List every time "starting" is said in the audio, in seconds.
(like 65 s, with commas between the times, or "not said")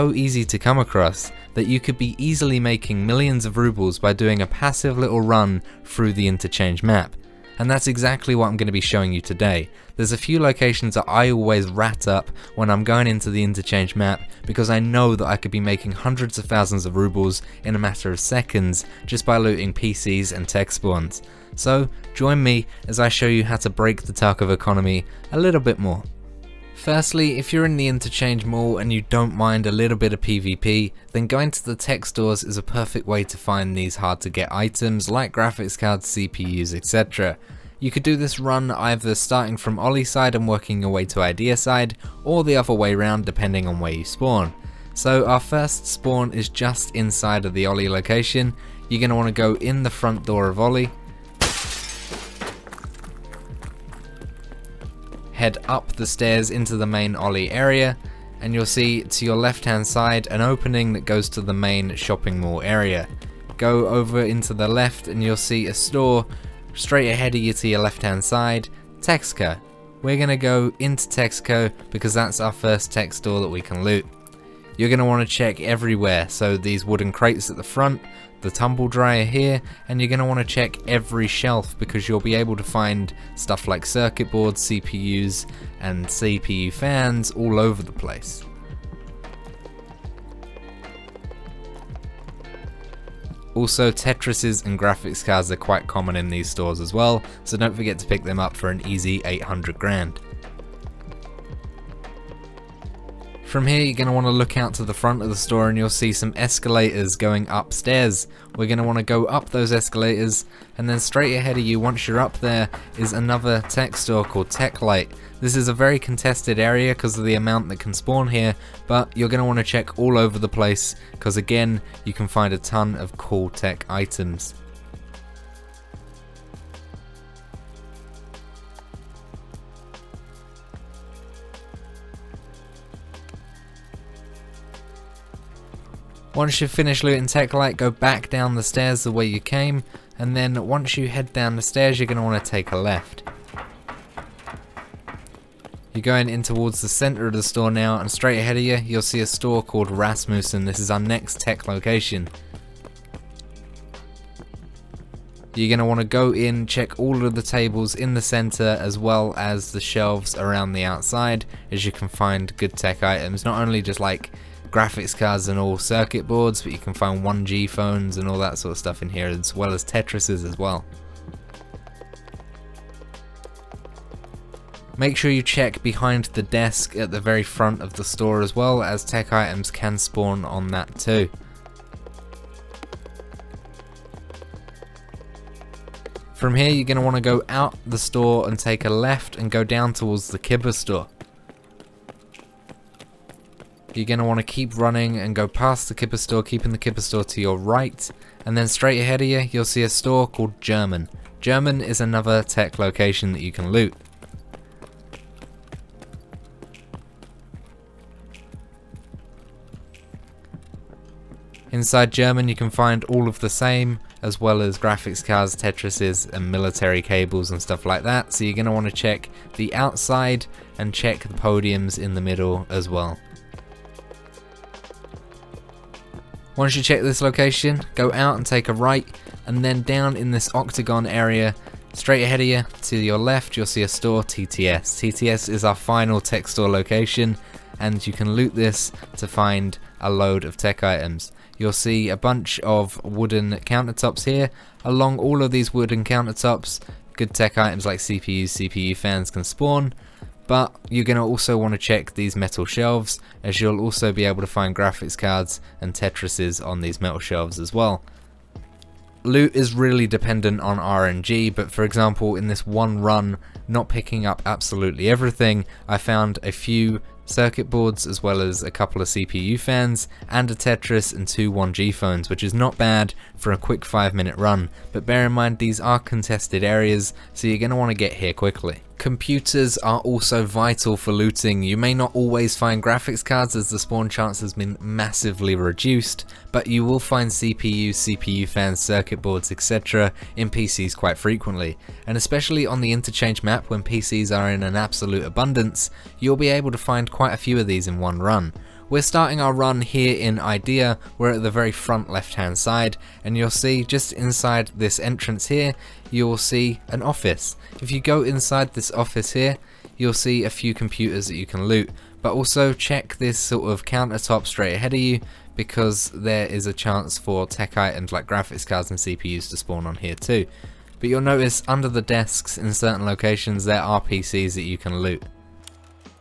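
39 s, 299 s.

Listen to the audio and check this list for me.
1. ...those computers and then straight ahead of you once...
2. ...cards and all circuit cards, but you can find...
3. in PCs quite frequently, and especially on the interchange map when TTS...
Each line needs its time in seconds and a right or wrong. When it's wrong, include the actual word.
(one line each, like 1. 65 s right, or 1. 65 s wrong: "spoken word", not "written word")
1. 109 s wrong: "escalators", not "computers"
2. 165 s wrong: "boards", not "cards"
3. 290 s wrong: "PCs", not "TTS".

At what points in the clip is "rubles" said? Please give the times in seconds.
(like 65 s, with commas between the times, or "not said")
3 s, 16 s.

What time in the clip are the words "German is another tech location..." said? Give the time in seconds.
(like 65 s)
201 s.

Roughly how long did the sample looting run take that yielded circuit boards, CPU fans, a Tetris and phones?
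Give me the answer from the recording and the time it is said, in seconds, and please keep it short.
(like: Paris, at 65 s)
5 minutes, at 273 s.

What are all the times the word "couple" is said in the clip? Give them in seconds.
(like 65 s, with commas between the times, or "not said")
268 s.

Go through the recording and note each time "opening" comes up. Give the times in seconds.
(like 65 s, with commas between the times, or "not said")
60 s.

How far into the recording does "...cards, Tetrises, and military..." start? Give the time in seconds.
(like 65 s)
215 s.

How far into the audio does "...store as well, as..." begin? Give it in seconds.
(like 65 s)
178 s.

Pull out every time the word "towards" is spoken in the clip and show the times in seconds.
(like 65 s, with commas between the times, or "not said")
146 s, 189 s.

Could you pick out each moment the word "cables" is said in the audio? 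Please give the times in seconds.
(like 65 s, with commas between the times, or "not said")
217 s.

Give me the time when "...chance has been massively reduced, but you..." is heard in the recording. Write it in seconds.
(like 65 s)
284 s.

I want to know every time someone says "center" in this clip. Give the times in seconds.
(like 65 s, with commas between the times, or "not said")
146 s, 158 s.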